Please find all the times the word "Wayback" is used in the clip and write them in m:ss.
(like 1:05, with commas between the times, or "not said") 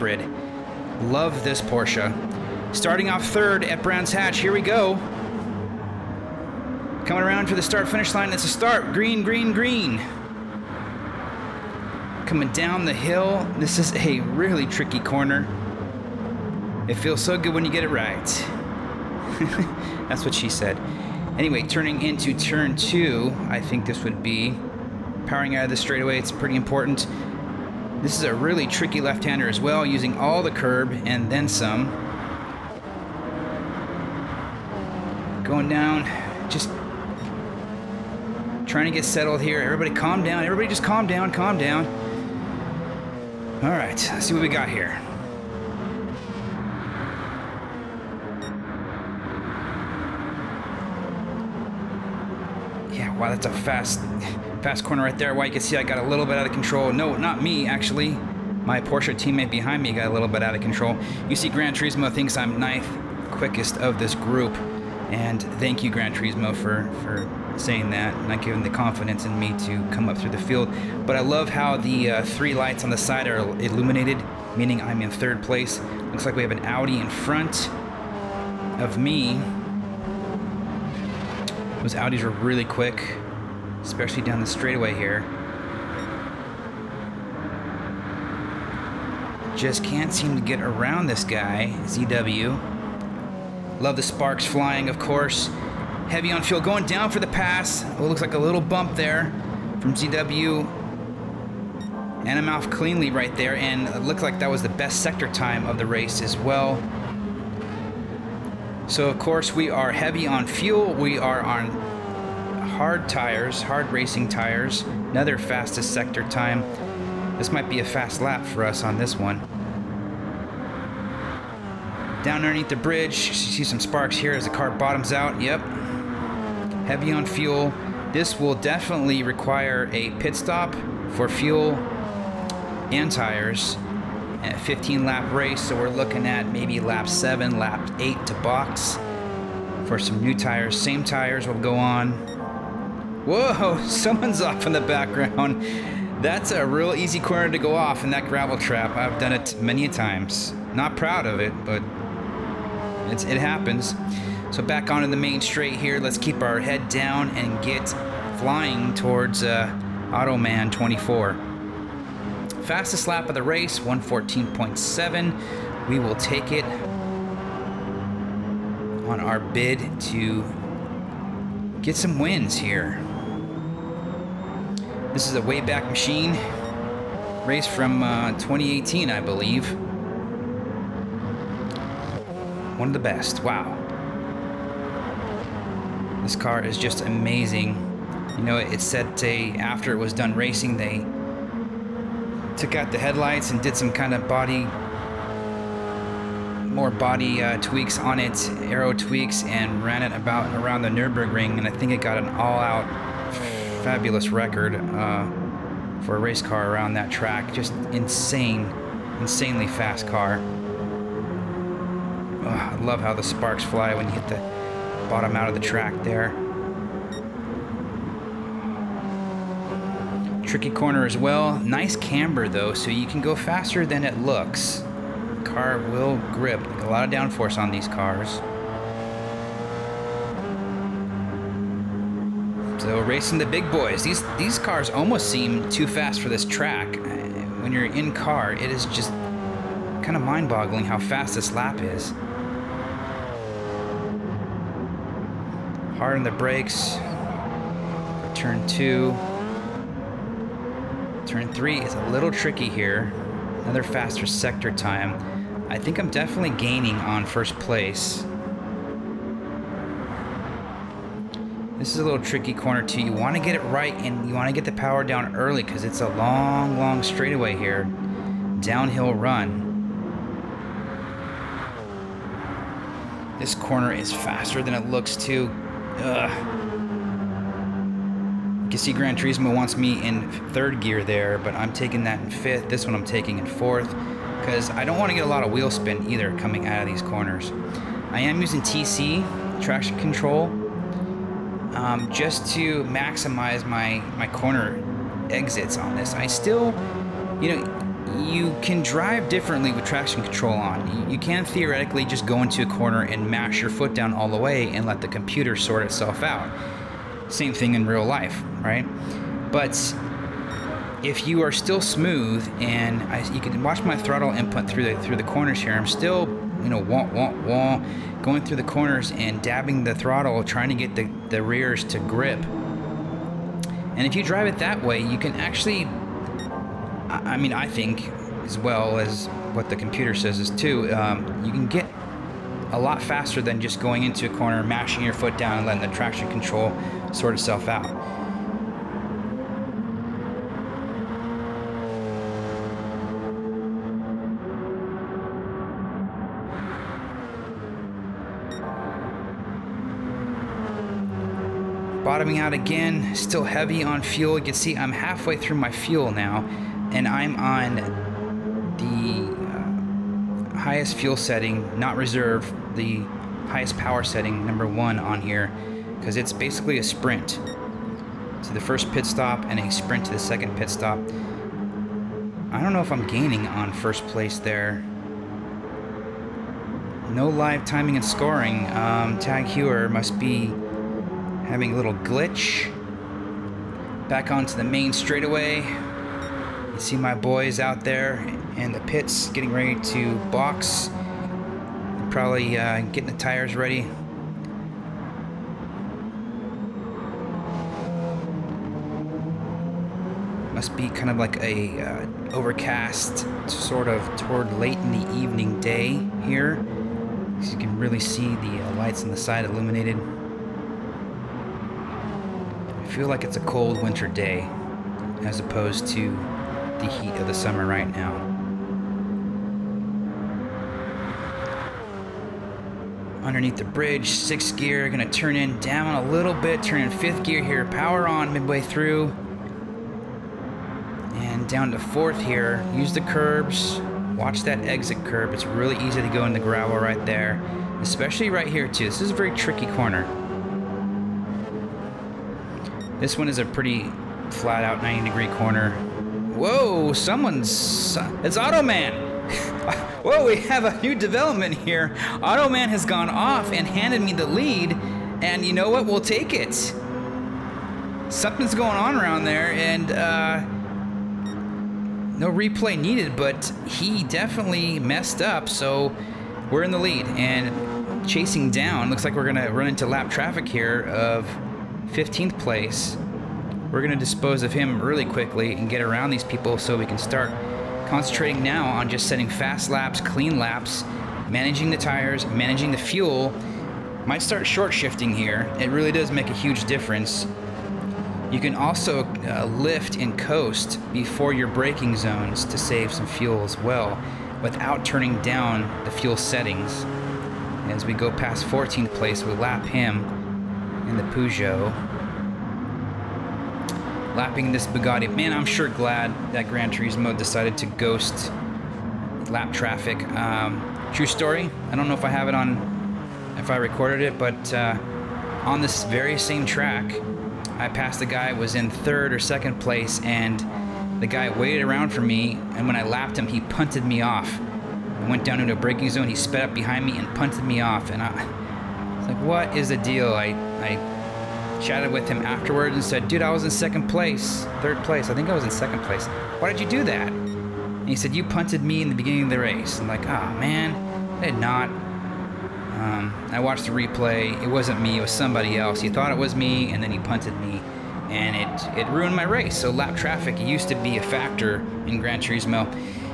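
2:55.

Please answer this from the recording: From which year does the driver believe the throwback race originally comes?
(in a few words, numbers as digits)
2018.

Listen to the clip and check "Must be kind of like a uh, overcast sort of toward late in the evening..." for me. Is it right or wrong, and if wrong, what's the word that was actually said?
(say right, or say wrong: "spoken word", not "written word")
right.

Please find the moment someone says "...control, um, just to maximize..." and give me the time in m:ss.
4:49.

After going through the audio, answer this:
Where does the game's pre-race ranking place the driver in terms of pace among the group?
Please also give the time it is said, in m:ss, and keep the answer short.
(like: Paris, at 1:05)
Ninth quickest, at 1:02.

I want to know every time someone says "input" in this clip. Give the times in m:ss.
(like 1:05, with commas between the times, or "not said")
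5:14.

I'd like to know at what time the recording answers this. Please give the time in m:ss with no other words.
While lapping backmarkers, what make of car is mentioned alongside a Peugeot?
8:24.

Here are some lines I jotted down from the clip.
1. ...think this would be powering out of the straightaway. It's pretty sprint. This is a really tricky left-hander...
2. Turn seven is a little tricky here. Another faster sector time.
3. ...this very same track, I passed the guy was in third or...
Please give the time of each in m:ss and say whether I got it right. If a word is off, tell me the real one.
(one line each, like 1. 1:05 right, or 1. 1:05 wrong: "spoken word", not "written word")
1. 0:23 wrong: "important", not "sprint"
2. 4:11 wrong: "three", not "seven"
3. 8:35 right.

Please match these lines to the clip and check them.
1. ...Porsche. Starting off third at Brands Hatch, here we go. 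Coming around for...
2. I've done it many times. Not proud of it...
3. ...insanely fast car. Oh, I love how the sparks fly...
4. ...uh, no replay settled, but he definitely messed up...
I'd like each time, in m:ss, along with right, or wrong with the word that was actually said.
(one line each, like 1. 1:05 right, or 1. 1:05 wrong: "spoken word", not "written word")
1. 0:01 right
2. 2:28 right
3. 3:29 right
4. 7:39 wrong: "needed", not "settled".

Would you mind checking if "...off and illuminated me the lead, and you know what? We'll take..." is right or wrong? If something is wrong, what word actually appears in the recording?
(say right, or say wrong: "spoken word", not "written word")
wrong: "handed", not "illuminated".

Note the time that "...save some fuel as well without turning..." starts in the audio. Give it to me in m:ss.
8:12.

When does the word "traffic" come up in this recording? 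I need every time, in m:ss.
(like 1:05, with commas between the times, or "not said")
7:50, 8:29, 9:09.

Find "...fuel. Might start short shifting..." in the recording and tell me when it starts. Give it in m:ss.
8:02.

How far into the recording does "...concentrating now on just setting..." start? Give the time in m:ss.
7:57.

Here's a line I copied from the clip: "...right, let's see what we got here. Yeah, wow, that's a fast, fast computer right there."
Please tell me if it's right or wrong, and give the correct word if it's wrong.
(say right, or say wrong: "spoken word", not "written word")
wrong: "corner", not "computer".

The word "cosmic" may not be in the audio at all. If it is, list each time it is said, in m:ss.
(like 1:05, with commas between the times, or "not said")
not said.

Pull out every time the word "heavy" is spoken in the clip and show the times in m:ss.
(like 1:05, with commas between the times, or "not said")
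1:36, 1:49, 2:06, 5:53.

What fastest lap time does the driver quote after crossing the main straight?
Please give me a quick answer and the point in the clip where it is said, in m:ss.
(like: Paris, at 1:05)
114.7, at 2:43.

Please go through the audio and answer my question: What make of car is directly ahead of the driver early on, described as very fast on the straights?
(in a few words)
Audi.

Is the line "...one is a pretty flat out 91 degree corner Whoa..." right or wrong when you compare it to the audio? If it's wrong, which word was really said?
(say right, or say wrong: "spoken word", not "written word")
wrong: "90", not "91".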